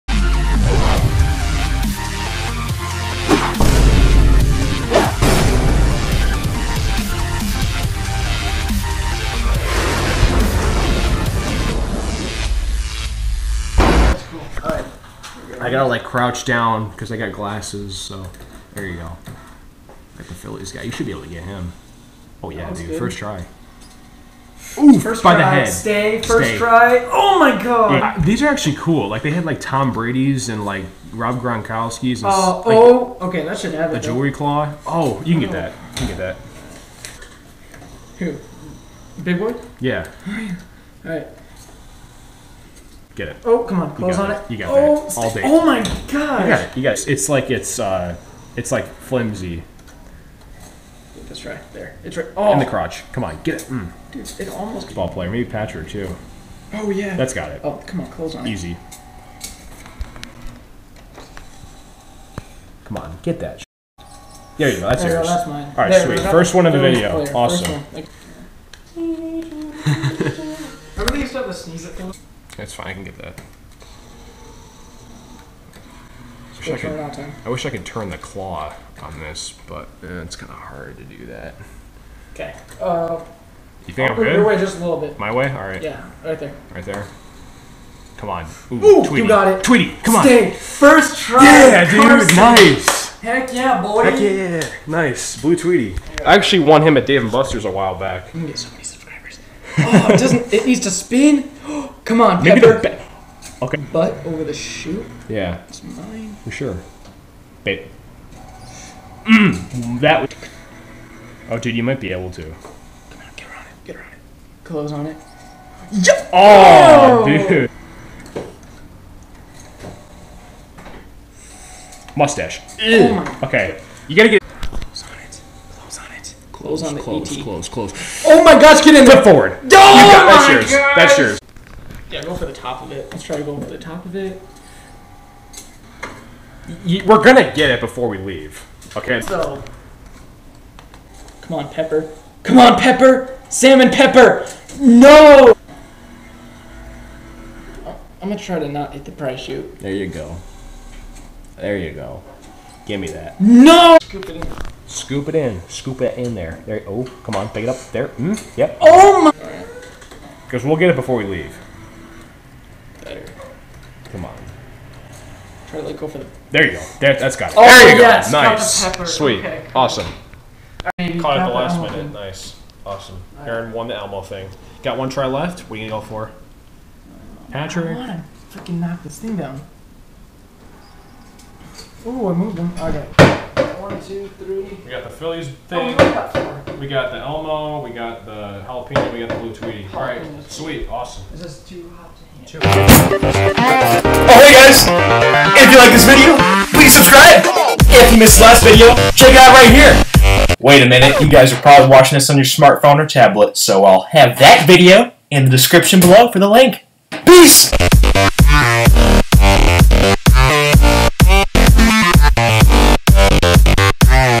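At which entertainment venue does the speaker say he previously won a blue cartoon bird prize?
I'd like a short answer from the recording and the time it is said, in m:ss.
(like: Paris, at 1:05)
Dave and Buster's, at 1:37.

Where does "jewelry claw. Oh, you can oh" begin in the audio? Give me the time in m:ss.
0:34.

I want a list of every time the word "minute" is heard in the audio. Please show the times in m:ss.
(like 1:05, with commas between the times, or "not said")
2:51, 3:20.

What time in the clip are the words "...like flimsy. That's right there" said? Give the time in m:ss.
0:48.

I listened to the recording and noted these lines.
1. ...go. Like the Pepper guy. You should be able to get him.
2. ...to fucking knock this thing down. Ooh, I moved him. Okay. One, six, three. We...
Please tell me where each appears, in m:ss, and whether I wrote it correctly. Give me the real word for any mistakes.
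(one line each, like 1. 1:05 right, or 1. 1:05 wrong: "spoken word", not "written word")
1. 0:18 wrong: "Phillies", not "Pepper"
2. 2:58 wrong: "two", not "six".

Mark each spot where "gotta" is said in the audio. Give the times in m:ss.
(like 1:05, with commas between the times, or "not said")
0:15, 2:04.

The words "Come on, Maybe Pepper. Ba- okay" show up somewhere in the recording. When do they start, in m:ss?
1:42.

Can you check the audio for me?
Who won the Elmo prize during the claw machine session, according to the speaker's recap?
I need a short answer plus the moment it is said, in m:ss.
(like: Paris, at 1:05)
Aaron, at 2:53.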